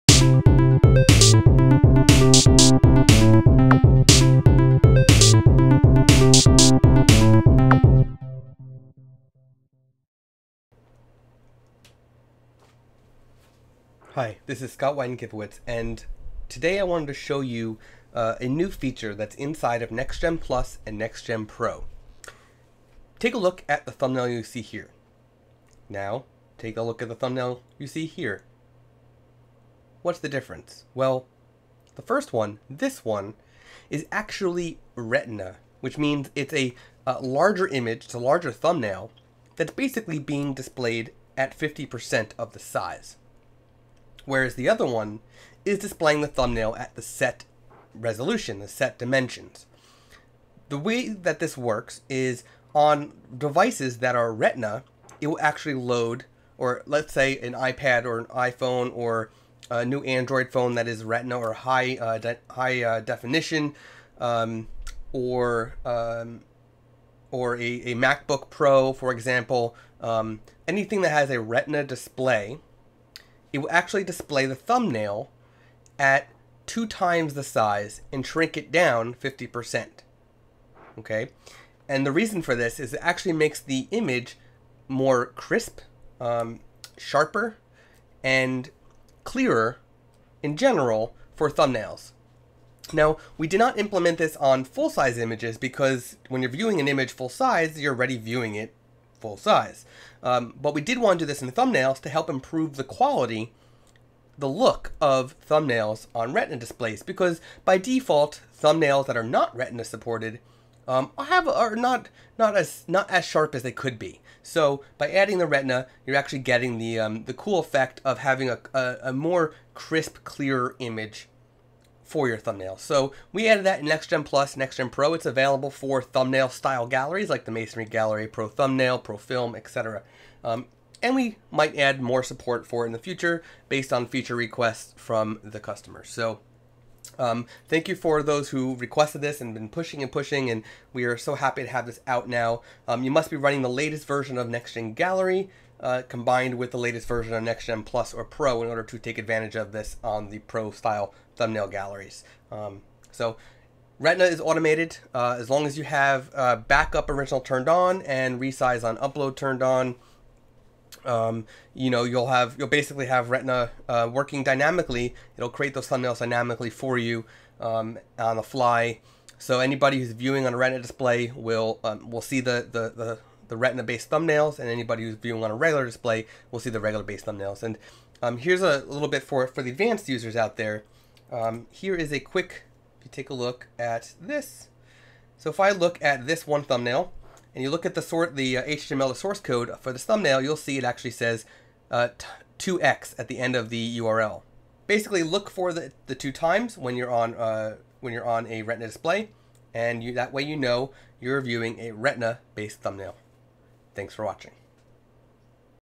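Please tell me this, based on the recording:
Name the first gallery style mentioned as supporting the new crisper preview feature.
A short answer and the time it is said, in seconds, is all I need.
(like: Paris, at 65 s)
Masonry Gallery, at 127 s.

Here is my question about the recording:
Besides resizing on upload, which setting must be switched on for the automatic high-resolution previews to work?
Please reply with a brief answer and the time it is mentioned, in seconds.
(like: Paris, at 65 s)
Backup original, at 156 s.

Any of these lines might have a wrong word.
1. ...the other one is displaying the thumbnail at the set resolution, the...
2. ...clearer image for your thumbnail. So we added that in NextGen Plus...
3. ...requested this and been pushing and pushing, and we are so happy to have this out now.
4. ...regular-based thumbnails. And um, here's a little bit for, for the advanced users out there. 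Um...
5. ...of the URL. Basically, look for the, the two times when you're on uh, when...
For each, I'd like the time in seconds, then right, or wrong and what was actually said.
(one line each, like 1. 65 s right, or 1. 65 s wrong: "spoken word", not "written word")
1. 44 s right
2. 120 s right
3. 138 s right
4. 176 s right
5. 193 s right.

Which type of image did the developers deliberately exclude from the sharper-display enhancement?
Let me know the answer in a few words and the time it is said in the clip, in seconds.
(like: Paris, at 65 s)
Full-size images, at 94 s.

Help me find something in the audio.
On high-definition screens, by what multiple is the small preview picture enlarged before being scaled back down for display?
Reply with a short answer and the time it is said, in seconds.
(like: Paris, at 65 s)
2 times, at 76 s.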